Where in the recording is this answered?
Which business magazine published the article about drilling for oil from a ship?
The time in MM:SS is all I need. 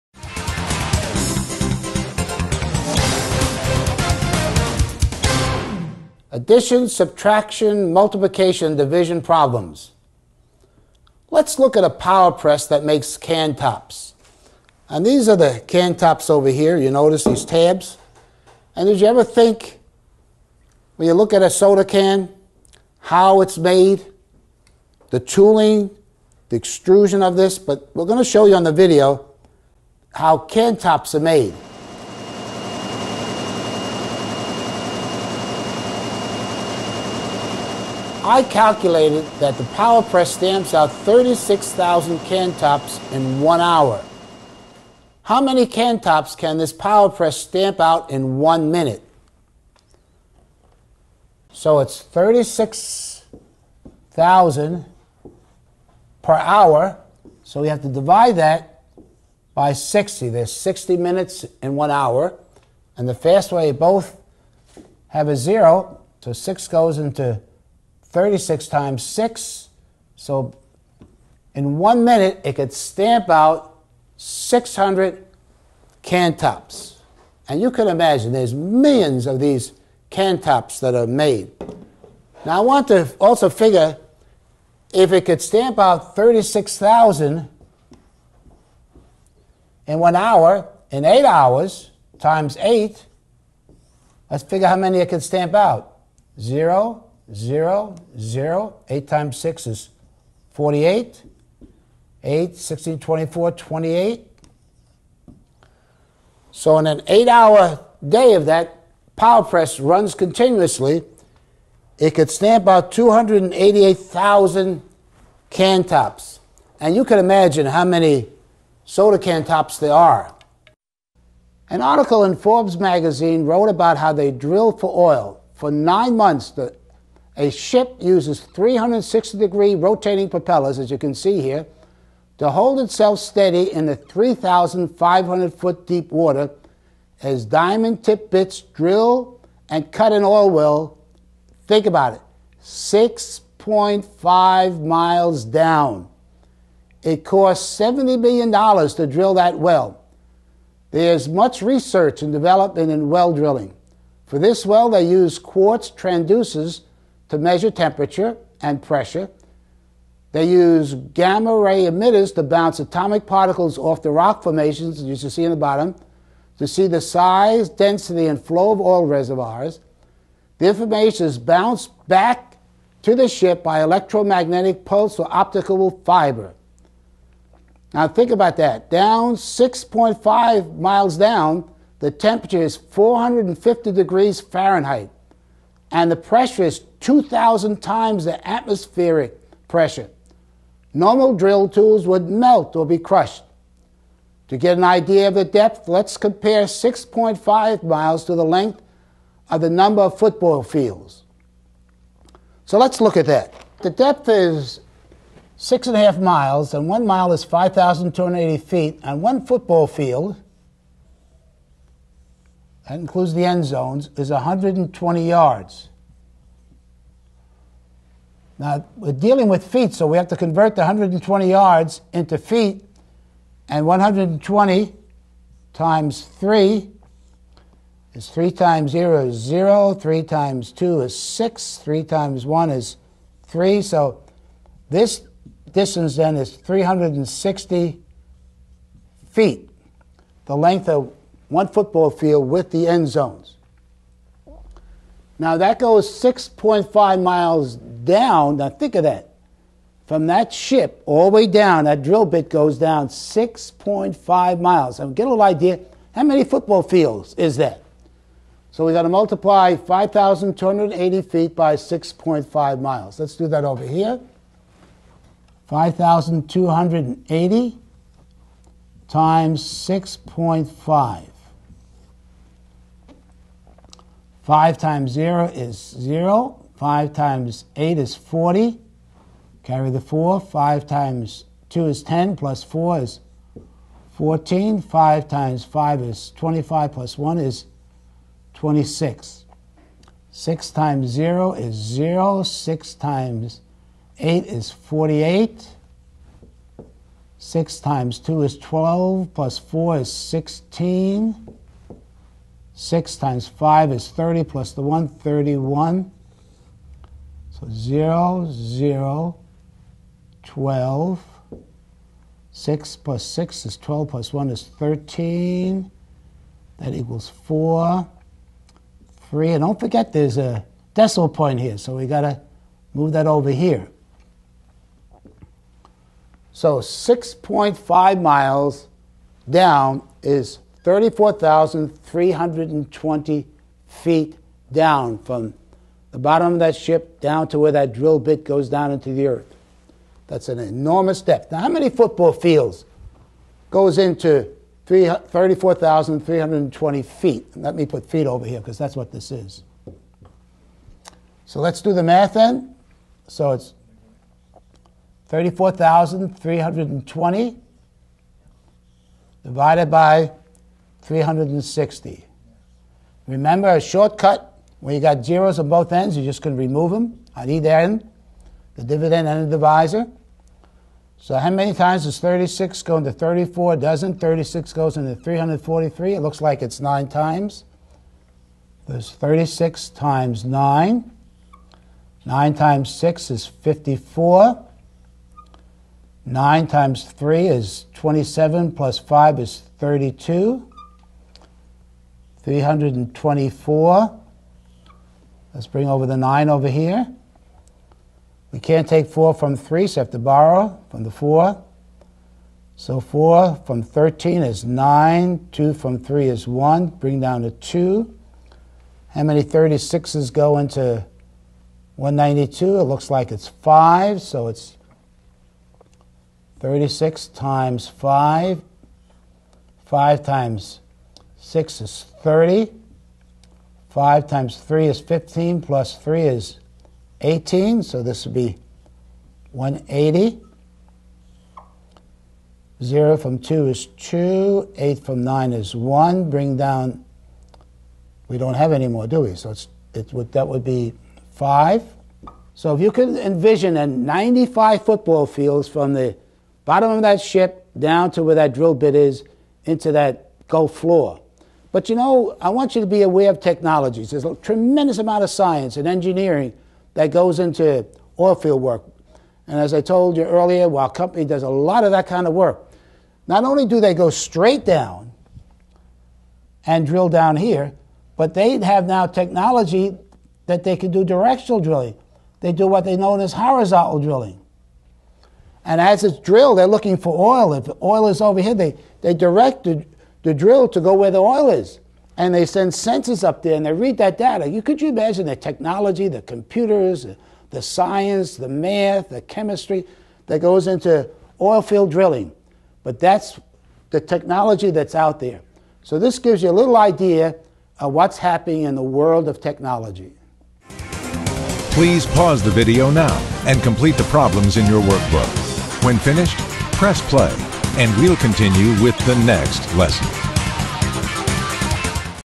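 02:02.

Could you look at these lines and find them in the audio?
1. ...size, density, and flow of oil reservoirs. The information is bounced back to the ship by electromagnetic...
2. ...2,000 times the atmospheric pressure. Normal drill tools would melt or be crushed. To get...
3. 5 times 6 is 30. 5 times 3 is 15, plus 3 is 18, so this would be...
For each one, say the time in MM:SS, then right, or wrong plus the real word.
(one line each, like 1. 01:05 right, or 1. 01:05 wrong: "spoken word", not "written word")
1. 02:46 right
2. 03:07 right
3. 06:59 right.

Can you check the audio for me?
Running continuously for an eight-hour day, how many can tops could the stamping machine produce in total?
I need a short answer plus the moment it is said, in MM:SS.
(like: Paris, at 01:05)
288,000, at 01:52.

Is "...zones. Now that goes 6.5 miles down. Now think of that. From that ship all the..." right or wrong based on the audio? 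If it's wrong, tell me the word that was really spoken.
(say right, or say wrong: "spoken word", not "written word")
right.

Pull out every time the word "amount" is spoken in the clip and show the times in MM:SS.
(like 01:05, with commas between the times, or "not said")
07:34.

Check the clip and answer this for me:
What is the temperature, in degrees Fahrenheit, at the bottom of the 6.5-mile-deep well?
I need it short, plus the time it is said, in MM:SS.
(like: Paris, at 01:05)
450, at 03:02.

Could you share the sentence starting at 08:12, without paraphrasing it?
But that's the technology that's out there.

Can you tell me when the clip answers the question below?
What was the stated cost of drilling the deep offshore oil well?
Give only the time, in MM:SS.
02:27.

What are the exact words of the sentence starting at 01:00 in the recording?
There's 60 minutes in one hour.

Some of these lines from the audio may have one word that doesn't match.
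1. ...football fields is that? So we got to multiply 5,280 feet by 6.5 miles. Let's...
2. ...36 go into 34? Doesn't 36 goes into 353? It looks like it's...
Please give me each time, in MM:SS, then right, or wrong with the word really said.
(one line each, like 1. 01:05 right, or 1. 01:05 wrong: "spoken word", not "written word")
1. 04:16 right
2. 06:12 wrong: "343", not "353".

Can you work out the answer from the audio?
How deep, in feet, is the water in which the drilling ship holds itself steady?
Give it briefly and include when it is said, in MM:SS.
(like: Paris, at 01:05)
3,500 feet, at 02:13.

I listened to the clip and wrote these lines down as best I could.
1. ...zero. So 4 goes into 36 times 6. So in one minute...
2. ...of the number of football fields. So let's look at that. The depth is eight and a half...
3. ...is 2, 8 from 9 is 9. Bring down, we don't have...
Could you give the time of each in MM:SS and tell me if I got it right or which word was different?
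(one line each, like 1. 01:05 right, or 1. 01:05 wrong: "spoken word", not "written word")
1. 01:05 wrong: "6", not "4"
2. 03:19 wrong: "six", not "eight"
3. 07:13 wrong: "1", not "9".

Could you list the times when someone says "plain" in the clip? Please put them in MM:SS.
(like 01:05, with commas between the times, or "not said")
not said.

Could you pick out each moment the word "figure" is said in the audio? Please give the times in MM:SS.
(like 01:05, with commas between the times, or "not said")
01:23, 01:34.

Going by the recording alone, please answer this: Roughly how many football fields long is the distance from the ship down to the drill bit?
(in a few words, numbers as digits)
95.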